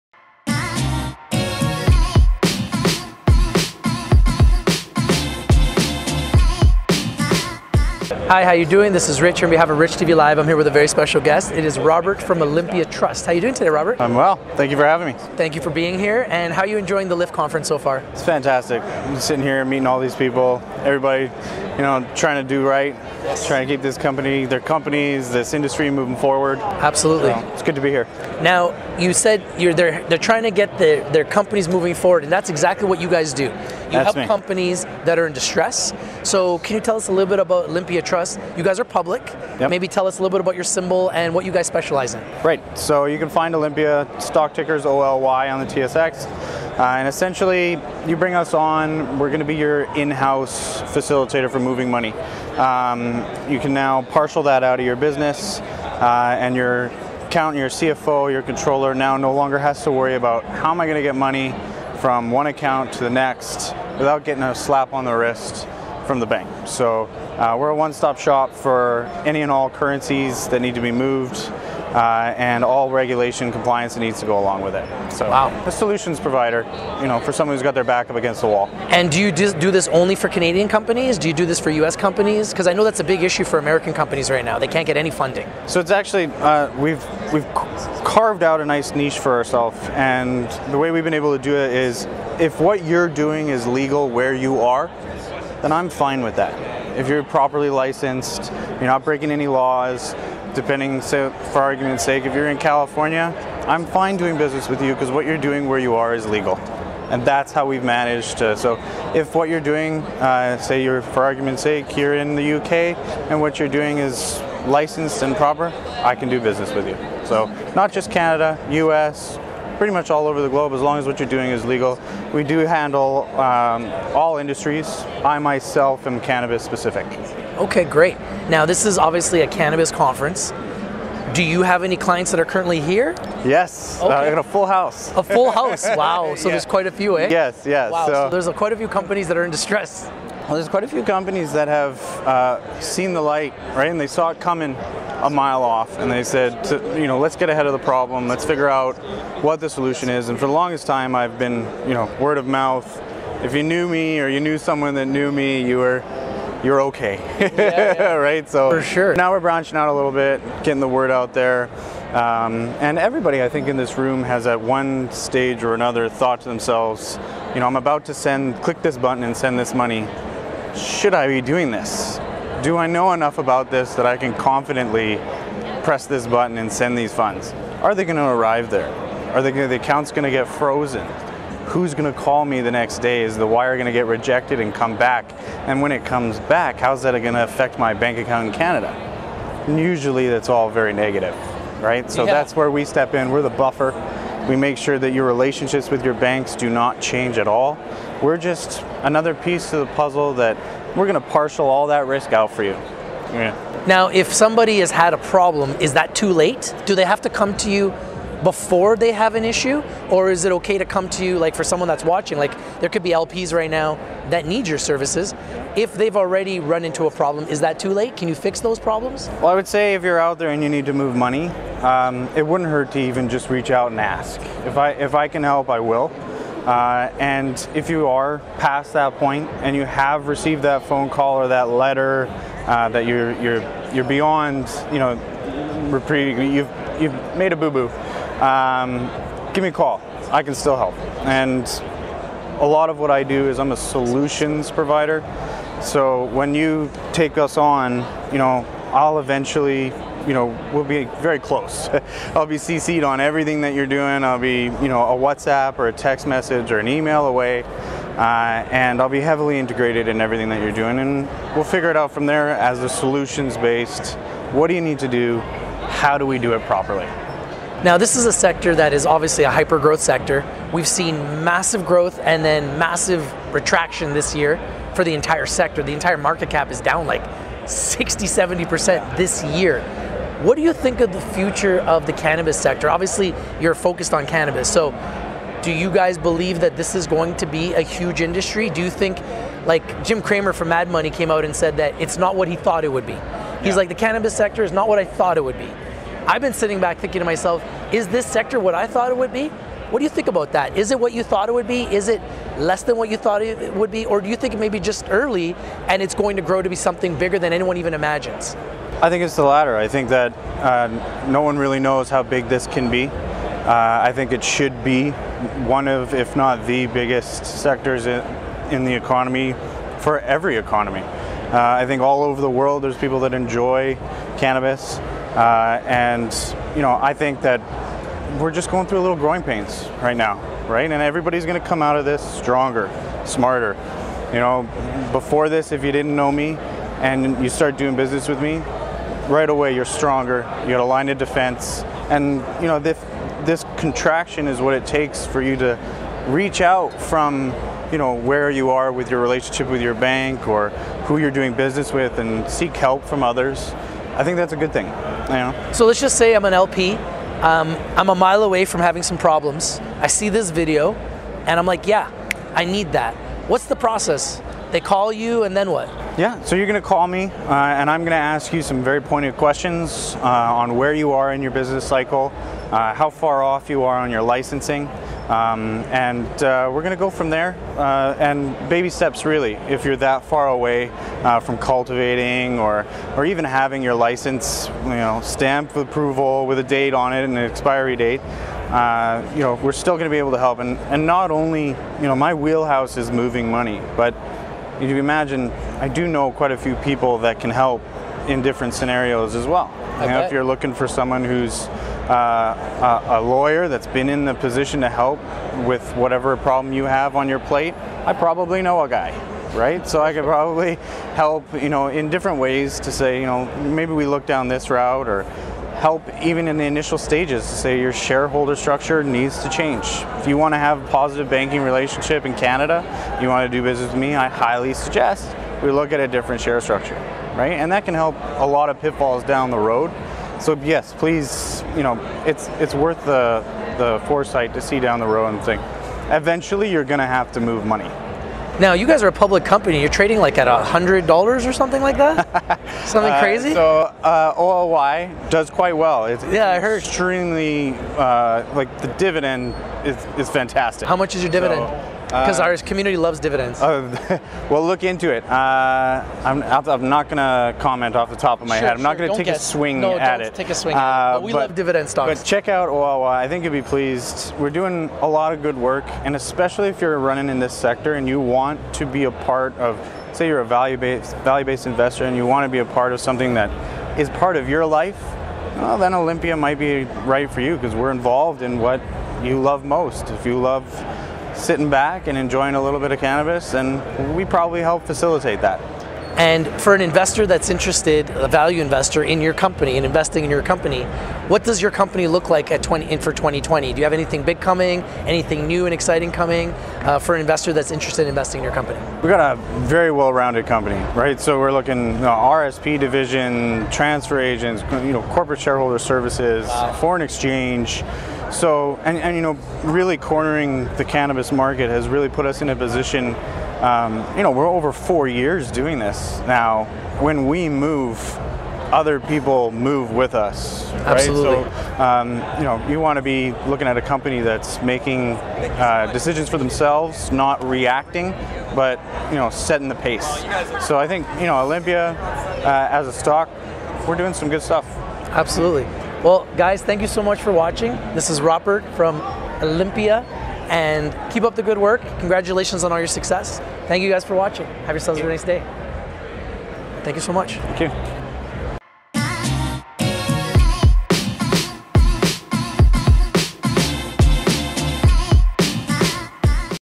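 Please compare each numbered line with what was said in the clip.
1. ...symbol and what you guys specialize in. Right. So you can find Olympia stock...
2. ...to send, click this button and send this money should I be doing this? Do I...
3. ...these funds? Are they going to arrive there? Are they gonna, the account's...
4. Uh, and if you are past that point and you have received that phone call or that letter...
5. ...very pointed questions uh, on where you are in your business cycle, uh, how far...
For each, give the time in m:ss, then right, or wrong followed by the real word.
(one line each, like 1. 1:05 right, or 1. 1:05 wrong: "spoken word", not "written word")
1. 0:40 right
2. 2:48 right
3. 2:56 right
4. 3:46 right
5. 6:08 right.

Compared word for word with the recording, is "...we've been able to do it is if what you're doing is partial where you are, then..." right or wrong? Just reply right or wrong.
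wrong.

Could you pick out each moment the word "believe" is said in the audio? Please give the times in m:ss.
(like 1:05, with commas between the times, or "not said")
4:46.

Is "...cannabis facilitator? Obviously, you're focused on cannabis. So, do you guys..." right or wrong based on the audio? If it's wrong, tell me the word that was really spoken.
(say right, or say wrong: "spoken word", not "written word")
wrong: "sector", not "facilitator".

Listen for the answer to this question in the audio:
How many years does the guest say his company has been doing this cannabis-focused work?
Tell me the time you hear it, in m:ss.
8:34.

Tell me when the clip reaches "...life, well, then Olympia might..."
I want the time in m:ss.
7:54.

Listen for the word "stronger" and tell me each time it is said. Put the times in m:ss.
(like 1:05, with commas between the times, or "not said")
5:32, 5:39.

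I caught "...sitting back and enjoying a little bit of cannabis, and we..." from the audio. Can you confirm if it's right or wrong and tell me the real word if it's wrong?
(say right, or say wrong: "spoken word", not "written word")
right.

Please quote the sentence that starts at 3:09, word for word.
And usually that's all very negative, right?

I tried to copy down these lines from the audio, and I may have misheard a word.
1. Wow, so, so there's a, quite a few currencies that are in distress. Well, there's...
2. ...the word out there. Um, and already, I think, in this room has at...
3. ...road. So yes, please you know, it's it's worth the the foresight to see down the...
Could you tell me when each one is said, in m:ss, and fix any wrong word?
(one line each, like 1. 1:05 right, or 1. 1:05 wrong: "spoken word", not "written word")
1. 2:17 wrong: "companies", not "currencies"
2. 2:40 wrong: "everybody", not "already"
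3. 7:09 right.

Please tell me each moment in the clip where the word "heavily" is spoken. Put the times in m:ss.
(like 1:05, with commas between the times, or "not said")
4:19.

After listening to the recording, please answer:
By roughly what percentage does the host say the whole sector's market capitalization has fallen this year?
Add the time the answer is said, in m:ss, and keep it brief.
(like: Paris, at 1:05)
60 to 70%, at 4:37.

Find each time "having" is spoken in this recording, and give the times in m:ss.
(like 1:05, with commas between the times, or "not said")
0:14, 5:58, 6:23.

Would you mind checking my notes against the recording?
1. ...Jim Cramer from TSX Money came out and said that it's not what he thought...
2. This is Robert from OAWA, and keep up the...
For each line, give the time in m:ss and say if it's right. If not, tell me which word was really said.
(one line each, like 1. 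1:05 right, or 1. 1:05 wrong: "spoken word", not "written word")
1. 4:50 wrong: "Mad", not "TSX"
2. 8:57 wrong: "Olympia", not "OAWA".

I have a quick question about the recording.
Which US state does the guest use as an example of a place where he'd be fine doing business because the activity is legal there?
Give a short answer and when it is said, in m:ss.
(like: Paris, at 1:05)
California, at 1:42.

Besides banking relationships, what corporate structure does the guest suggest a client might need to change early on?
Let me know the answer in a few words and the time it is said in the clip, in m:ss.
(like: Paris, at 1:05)
Shareholder structure, at 6:57.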